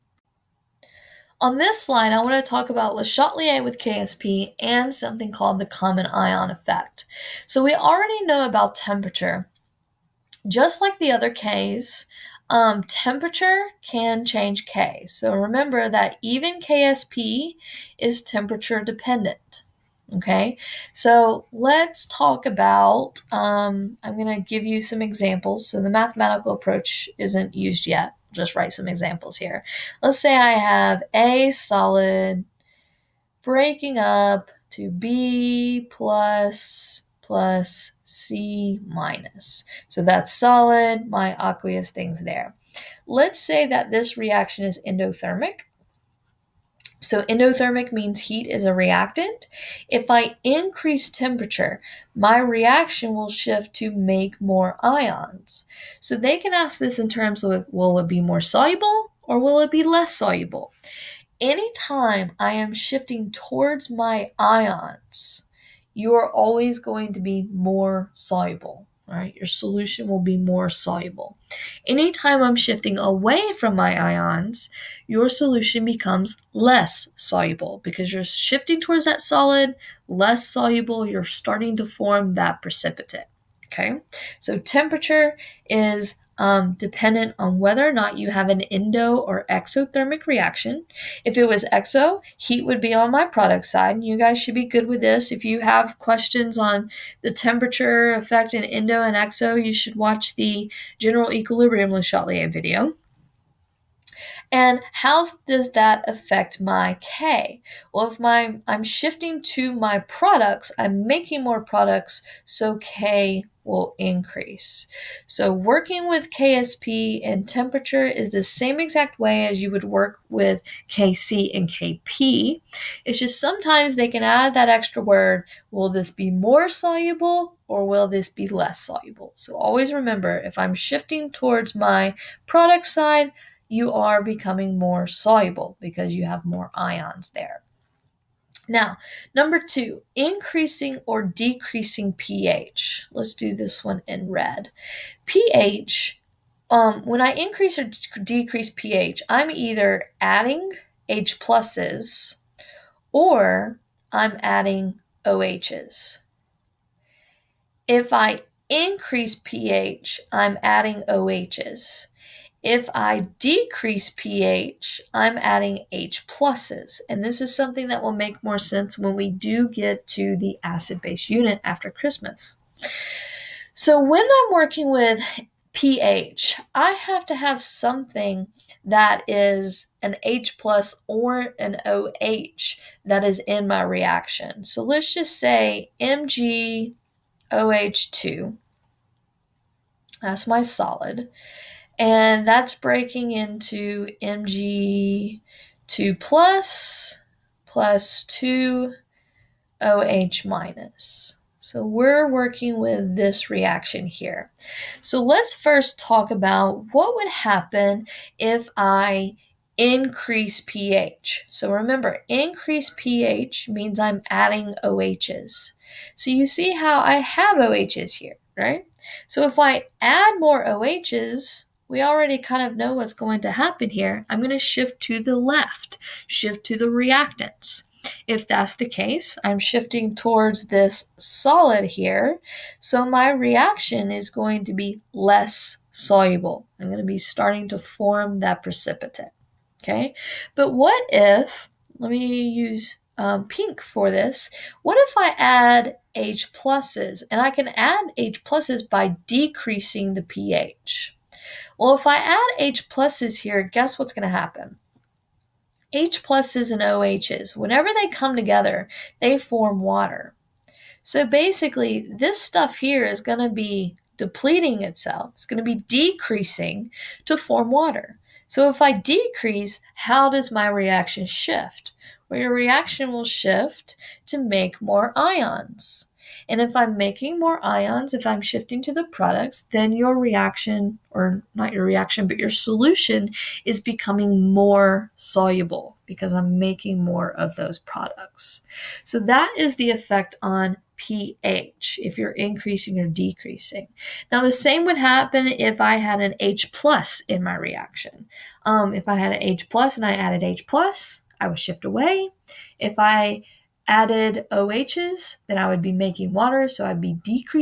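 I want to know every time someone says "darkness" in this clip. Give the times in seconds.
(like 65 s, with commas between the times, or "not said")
not said.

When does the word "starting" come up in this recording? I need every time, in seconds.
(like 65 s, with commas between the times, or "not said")
81 s, 237 s.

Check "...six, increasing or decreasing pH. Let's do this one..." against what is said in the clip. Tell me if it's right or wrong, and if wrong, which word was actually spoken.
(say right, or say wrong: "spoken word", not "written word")
wrong: "two", not "six".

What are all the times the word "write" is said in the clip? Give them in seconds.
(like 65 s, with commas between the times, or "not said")
28 s.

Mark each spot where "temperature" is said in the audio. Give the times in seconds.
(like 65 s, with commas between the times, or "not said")
8 s, 12 s, 18 s, 51 s, 84 s, 97 s, 117 s.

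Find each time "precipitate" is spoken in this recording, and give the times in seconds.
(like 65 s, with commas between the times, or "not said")
82 s, 238 s.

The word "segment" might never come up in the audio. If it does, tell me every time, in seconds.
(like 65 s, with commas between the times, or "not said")
not said.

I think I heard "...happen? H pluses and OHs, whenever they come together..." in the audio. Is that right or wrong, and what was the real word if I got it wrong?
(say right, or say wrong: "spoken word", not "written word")
right.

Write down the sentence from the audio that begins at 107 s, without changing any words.
Well, if my I'm shifting to my products, I'm making more products, so K will increase.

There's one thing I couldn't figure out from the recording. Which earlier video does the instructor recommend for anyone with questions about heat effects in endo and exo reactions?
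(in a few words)
General equilibrium Le Chatelier video.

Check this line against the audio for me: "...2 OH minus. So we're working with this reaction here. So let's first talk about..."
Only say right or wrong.
right.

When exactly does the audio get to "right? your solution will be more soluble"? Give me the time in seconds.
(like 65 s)
69 s.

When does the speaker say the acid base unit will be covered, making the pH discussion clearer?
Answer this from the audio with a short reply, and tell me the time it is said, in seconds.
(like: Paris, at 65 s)
After Christmas, at 171 s.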